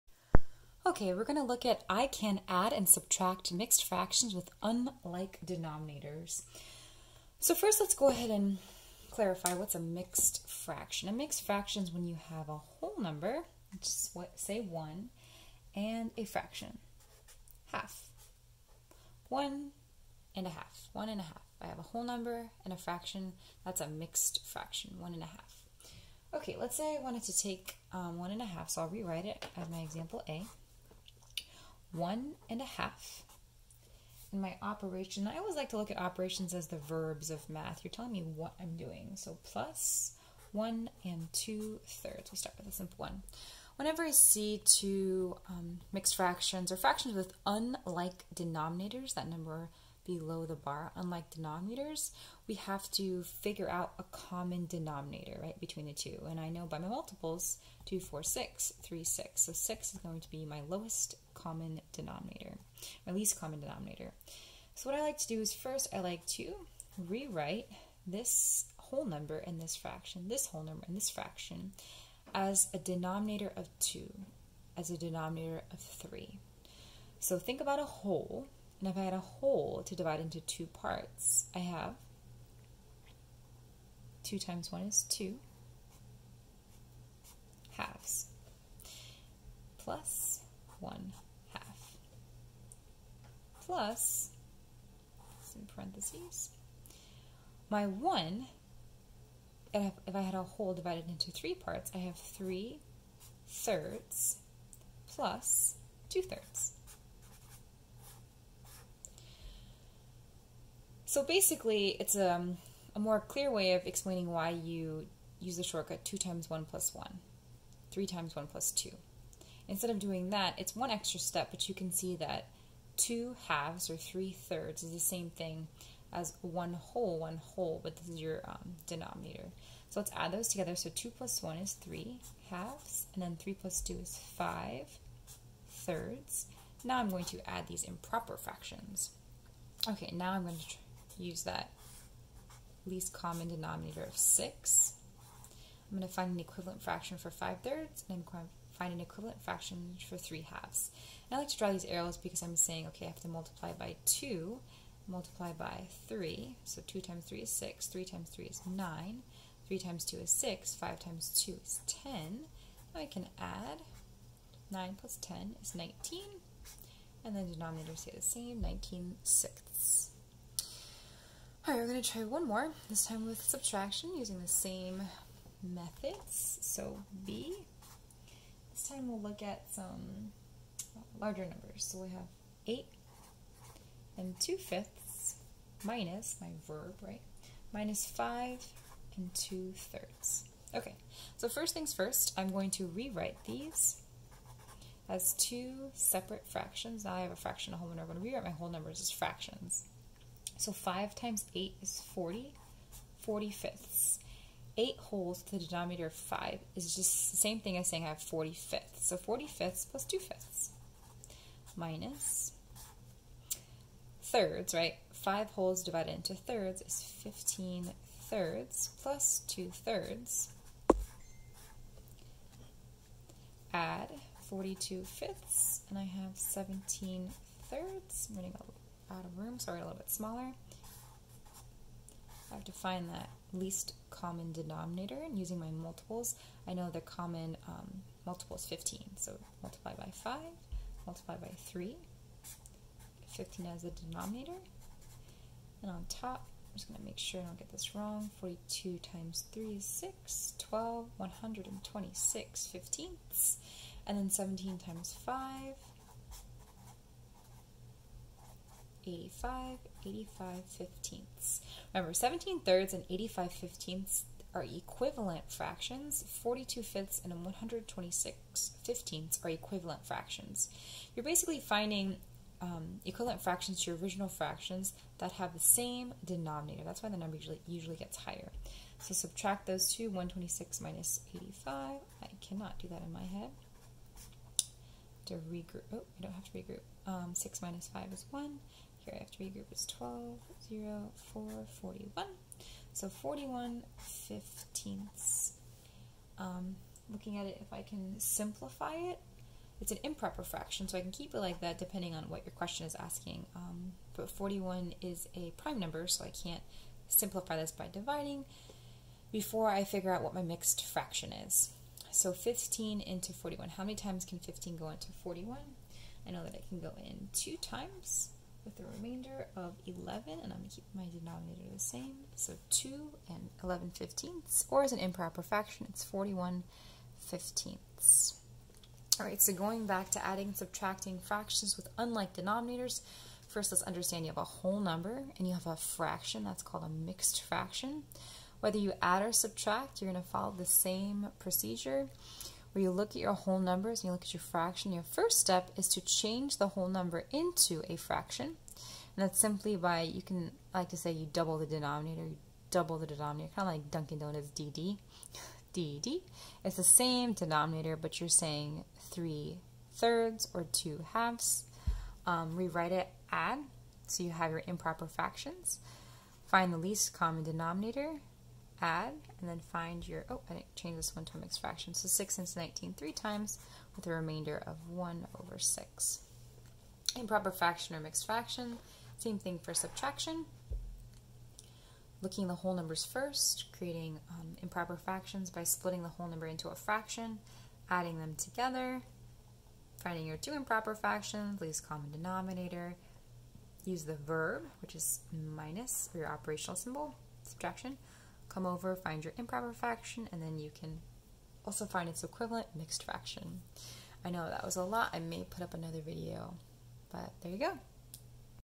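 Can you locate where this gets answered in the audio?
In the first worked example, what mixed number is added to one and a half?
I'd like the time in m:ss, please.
0:40.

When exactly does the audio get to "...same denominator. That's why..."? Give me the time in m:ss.
4:35.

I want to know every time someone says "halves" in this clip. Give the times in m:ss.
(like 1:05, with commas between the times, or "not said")
1:27, 2:03, 2:12, 2:30, 6:01.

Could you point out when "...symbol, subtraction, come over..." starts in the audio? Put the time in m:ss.
6:36.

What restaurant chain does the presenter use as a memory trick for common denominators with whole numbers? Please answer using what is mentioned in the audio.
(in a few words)
Dunkin' Donuts.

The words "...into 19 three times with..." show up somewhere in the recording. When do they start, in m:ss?
6:12.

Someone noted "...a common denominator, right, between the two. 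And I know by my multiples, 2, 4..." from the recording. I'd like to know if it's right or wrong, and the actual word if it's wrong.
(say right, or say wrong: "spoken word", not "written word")
right.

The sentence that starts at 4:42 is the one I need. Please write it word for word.
I cannot do that in my head.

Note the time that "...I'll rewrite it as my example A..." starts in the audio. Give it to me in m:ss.
0:28.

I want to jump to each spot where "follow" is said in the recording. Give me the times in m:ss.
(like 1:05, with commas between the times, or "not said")
5:40.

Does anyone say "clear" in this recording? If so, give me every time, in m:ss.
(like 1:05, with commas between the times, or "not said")
1:53.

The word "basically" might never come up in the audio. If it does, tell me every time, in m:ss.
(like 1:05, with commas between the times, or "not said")
1:51, 4:31.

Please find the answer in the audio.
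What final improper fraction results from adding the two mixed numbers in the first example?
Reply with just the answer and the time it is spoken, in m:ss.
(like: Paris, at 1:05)
19/6, at 2:48.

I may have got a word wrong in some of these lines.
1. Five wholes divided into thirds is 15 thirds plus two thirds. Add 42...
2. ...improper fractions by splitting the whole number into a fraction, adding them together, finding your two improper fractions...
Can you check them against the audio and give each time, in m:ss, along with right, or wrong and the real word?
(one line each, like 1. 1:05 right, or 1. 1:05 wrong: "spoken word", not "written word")
1. 3:35 right
2. 6:24 right.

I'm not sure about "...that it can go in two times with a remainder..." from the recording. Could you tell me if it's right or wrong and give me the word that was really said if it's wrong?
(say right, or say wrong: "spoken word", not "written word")
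right.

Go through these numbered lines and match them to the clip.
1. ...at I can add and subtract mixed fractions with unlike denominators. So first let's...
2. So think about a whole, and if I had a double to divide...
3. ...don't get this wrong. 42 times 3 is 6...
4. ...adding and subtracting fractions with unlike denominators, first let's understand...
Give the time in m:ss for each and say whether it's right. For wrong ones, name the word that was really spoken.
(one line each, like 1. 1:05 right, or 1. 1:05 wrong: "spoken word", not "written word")
1. 0:01 right
2. 1:17 wrong: "whole", not "double"
3. 4:07 right
4. 5:30 right.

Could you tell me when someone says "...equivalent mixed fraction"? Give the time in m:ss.
6:42.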